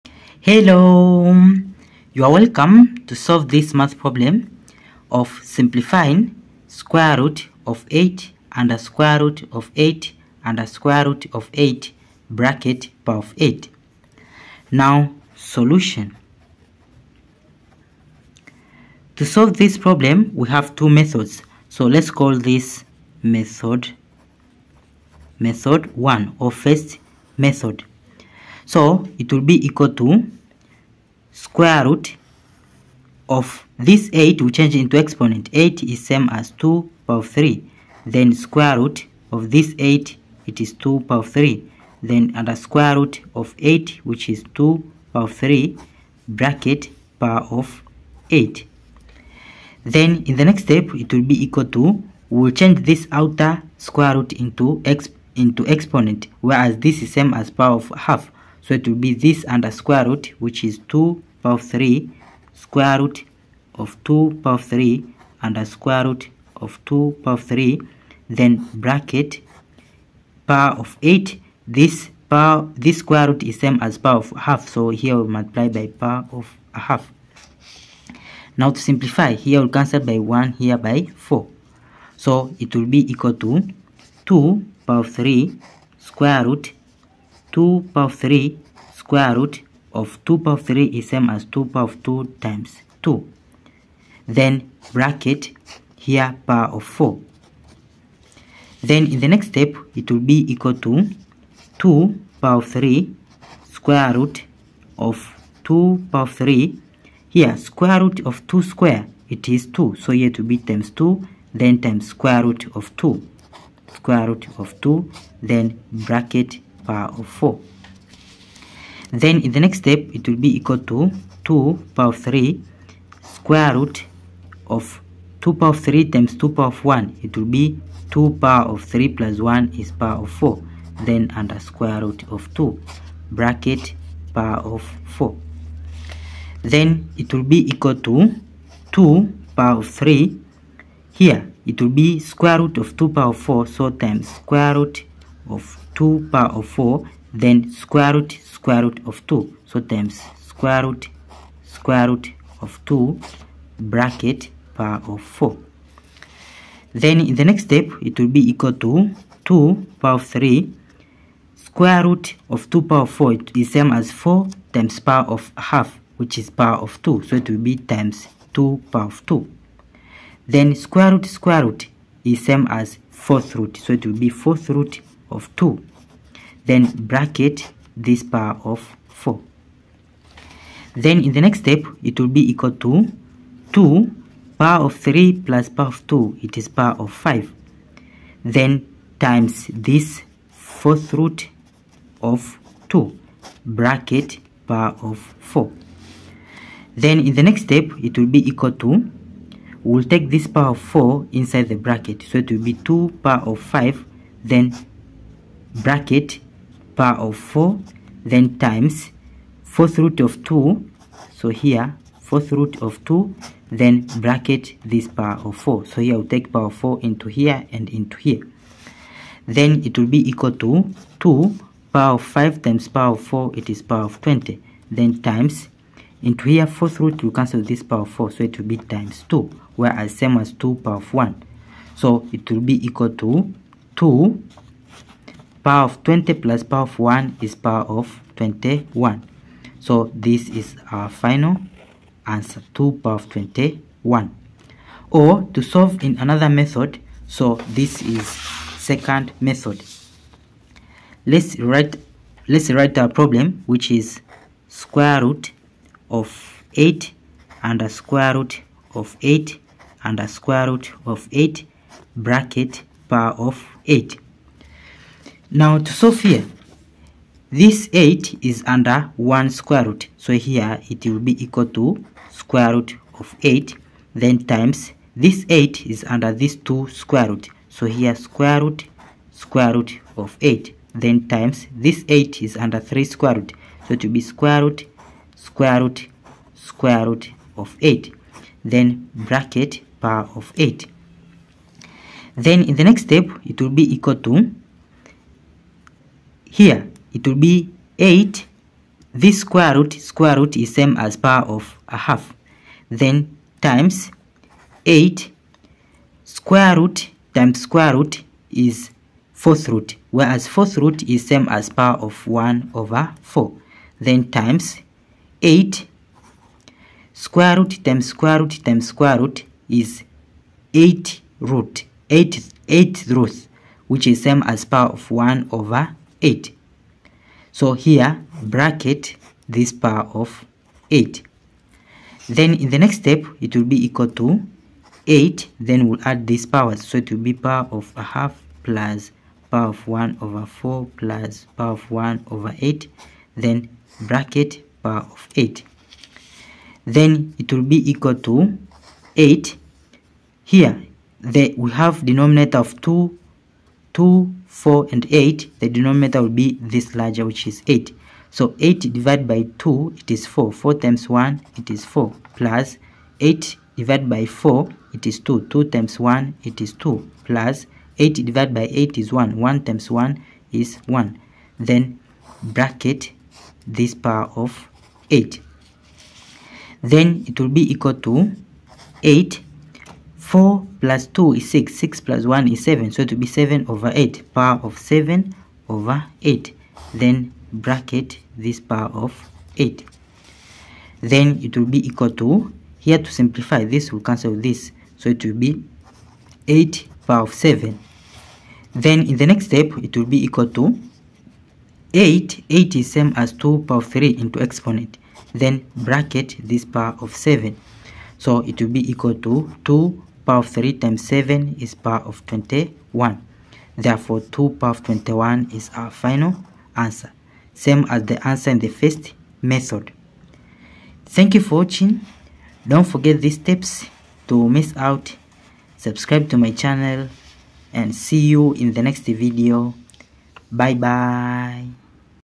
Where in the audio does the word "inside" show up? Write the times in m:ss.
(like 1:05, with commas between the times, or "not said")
3:21.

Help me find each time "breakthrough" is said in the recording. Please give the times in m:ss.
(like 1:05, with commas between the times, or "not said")
not said.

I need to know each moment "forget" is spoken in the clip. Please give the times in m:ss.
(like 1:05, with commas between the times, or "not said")
7:02.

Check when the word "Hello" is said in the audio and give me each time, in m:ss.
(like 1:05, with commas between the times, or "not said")
0:00.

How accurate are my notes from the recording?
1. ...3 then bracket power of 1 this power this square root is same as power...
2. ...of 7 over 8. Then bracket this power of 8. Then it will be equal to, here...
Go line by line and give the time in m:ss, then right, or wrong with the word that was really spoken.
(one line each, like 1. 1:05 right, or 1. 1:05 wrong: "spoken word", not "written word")
1. 1:07 wrong: "8", not "1"
2. 6:24 right.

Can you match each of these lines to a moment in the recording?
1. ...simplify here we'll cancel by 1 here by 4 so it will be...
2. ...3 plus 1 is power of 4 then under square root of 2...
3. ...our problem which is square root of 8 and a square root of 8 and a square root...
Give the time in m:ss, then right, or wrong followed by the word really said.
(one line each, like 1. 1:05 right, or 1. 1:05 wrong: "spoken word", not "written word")
1. 1:18 right
2. 2:08 right
3. 4:12 right.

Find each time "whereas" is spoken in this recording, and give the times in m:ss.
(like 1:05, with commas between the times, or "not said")
0:56, 3:49, 5:10.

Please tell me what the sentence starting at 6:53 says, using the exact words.
Therefore, 2 power of 21 is our final answer.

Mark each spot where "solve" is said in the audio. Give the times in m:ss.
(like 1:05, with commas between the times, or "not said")
0:03, 0:19, 4:05.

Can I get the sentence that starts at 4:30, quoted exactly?
So here it will be equal to square root of 8 then times this 8 is under this 2 square root.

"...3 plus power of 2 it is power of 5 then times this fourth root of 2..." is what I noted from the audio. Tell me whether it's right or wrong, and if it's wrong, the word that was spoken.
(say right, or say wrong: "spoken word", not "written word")
right.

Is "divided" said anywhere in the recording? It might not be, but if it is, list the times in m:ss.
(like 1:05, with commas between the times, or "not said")
5:58, 6:03, 6:08.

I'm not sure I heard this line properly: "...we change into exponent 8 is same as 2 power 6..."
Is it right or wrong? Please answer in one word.
wrong.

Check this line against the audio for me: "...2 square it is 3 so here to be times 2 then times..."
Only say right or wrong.
wrong.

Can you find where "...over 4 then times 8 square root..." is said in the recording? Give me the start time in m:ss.
5:12.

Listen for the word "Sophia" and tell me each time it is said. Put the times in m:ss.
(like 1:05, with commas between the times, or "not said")
4:25.